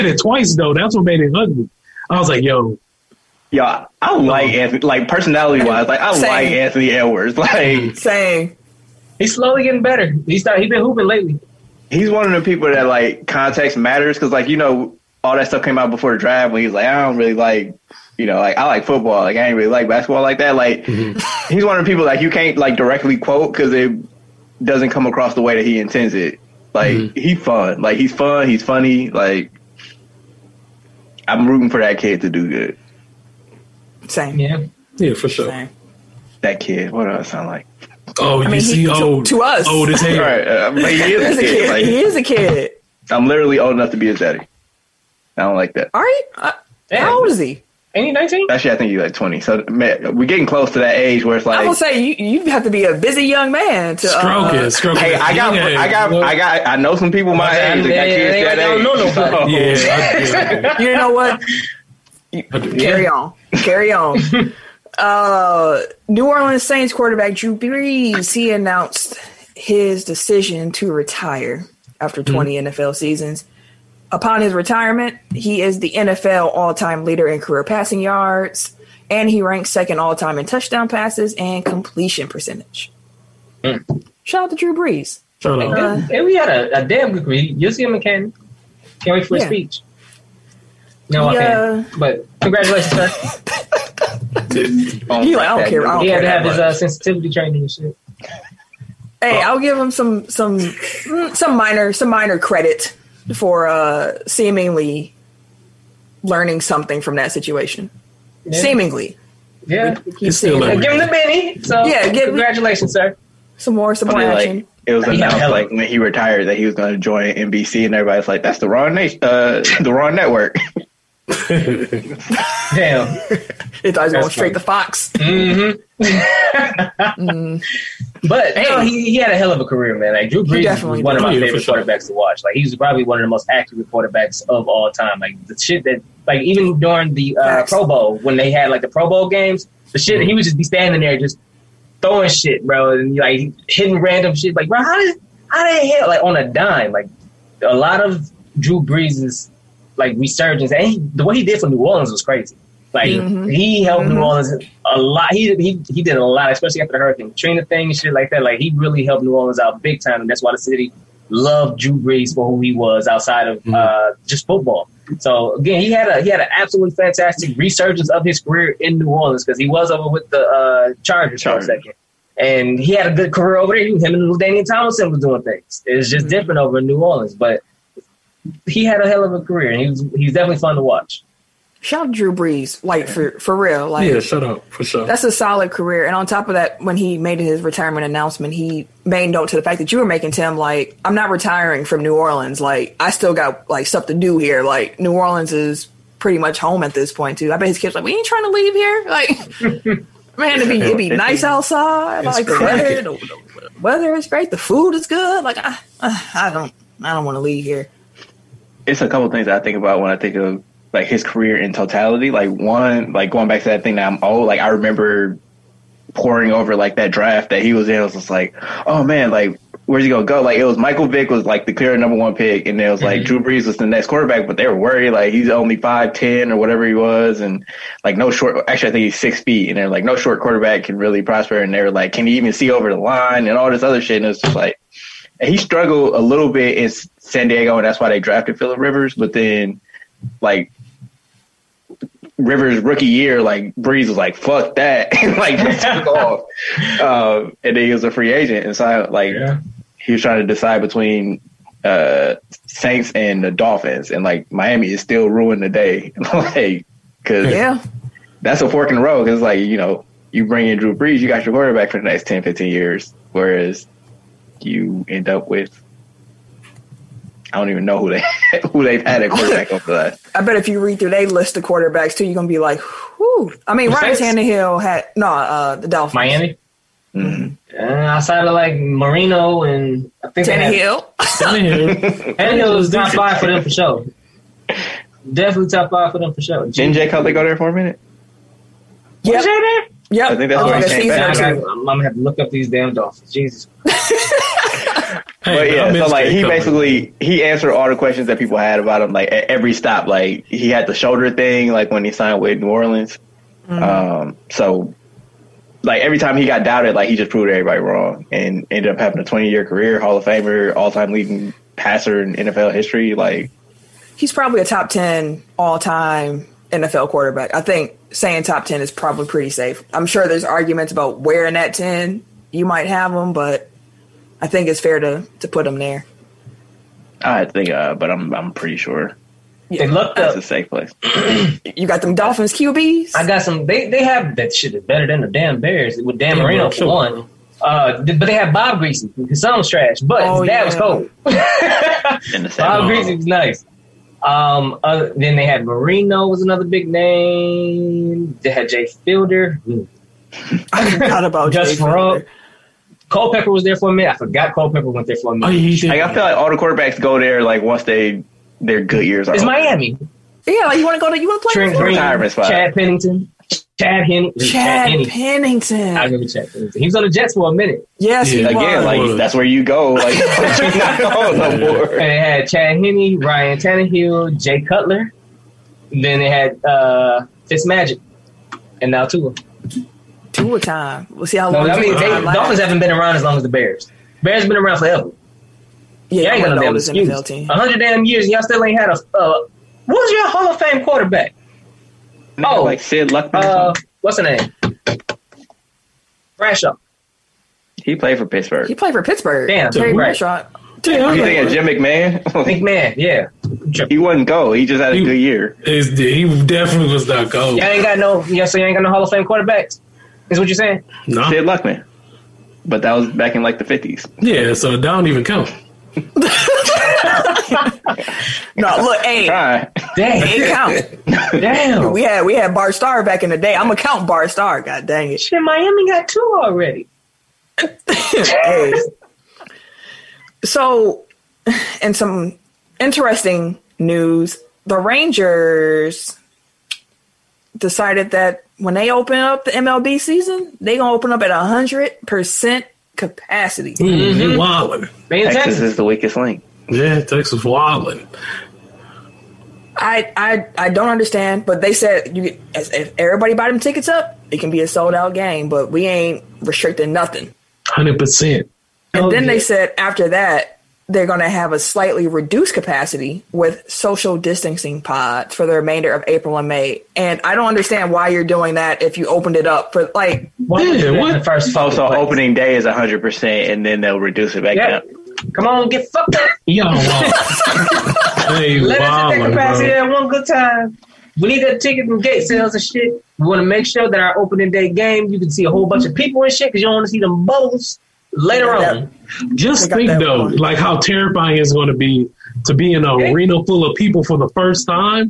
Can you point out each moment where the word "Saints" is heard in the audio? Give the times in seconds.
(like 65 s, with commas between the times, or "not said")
66 s, 252 s.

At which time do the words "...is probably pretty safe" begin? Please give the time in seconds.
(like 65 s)
318 s.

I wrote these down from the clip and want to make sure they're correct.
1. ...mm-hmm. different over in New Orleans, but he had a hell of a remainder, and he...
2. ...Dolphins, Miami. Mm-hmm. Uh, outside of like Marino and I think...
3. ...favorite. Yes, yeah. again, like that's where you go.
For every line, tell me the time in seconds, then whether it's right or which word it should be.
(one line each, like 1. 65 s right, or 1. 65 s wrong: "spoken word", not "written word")
1. 176 s wrong: "career", not "remainder"
2. 275 s right
3. 367 s wrong: "minute", not "favorite".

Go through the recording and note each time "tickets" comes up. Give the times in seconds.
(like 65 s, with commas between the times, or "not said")
453 s, 481 s.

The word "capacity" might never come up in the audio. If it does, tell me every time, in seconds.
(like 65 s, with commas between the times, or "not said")
442 s, 462 s, 479 s.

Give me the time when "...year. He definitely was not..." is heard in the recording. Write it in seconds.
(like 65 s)
405 s.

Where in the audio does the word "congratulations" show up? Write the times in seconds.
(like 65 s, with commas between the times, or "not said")
92 s, 112 s.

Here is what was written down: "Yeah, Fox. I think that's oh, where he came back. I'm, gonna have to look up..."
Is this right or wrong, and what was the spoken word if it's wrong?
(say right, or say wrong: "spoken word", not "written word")
wrong: "Yep", not "Fox".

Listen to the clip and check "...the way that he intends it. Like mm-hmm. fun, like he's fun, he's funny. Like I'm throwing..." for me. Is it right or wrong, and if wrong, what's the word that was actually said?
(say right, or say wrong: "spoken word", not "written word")
wrong: "rooting", not "throwing".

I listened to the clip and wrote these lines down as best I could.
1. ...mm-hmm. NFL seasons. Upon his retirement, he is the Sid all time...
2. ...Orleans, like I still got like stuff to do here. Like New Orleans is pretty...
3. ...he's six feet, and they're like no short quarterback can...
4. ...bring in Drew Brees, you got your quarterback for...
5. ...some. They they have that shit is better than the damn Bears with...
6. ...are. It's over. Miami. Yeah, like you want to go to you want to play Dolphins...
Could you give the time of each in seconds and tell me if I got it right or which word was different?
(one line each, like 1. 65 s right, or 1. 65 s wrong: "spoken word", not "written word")
1. 72 s wrong: "NFL", not "Sid"
2. 192 s right
3. 229 s right
4. 260 s right
5. 333 s right
6. 359 s wrong: "Trent", not "Dolphins".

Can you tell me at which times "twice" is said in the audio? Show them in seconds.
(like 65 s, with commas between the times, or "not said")
0 s.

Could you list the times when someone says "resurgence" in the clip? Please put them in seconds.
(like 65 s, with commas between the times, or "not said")
150 s, 167 s.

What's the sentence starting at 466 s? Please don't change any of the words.
And I don't understand why you're doing that if you opened it up for like.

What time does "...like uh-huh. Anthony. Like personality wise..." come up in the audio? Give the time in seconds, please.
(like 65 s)
4 s.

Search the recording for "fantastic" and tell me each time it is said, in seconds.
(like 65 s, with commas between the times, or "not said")
166 s.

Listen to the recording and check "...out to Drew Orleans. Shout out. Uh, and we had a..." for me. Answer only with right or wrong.
wrong.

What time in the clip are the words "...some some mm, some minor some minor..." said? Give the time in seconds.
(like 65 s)
99 s.